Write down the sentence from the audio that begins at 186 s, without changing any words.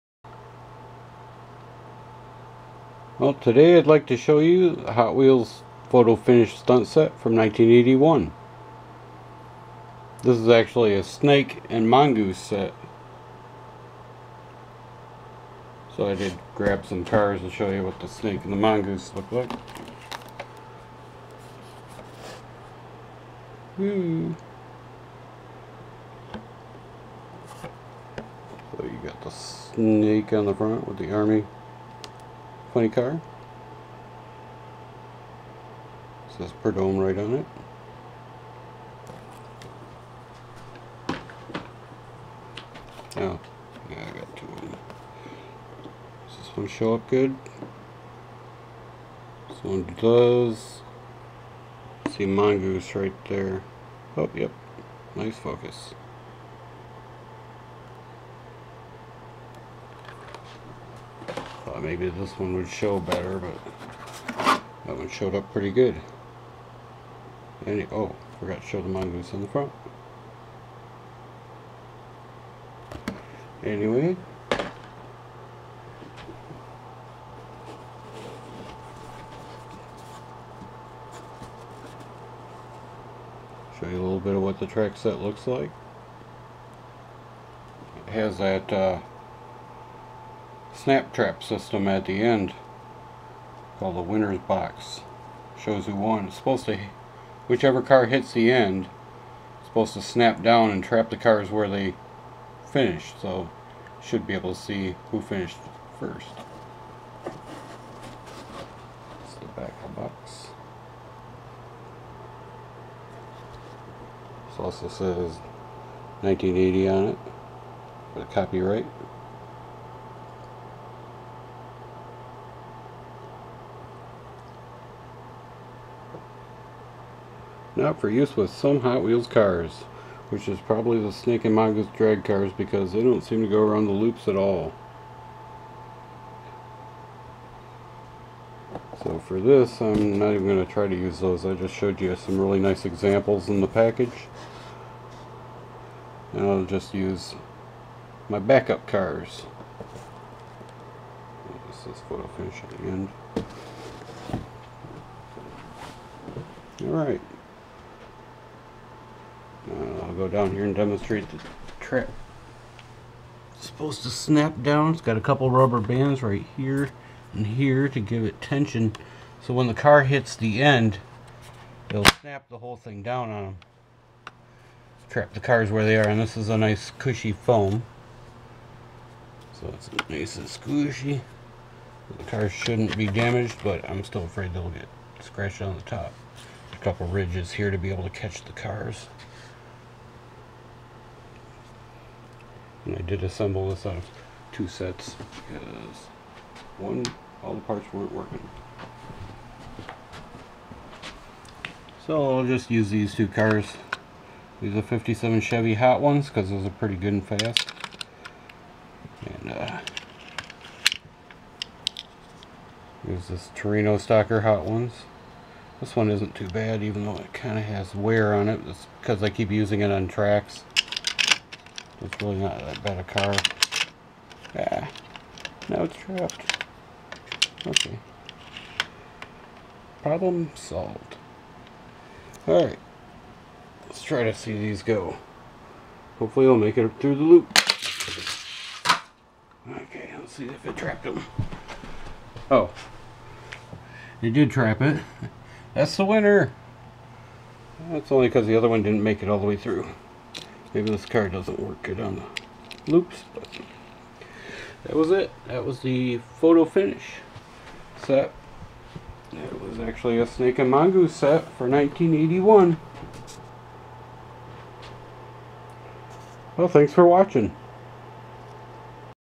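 A couple ridges here to be able to catch the cars.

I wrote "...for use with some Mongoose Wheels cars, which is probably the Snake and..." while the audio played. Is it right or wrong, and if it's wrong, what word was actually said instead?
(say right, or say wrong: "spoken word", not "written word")
wrong: "Hot", not "Mongoose".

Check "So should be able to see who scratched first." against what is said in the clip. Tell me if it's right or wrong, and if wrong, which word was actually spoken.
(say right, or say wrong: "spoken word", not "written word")
wrong: "finished", not "scratched".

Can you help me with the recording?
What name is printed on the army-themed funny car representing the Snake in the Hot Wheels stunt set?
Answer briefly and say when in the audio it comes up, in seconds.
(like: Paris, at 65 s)
Prudhomme, at 36 s.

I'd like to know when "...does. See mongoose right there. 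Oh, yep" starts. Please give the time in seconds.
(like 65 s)
49 s.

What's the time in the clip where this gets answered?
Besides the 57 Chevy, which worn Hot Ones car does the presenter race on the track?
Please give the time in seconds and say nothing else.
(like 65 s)
213 s.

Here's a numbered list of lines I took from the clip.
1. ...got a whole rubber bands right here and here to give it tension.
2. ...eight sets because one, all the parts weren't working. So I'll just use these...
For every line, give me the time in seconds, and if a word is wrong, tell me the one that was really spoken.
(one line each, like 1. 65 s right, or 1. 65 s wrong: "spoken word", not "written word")
1. 165 s wrong: "couple", not "whole"
2. 194 s wrong: "two", not "eight".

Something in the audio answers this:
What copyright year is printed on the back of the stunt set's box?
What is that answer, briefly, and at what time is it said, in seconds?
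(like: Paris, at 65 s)
1980, at 116 s.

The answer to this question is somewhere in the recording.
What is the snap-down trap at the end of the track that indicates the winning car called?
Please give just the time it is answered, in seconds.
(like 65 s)
94 s.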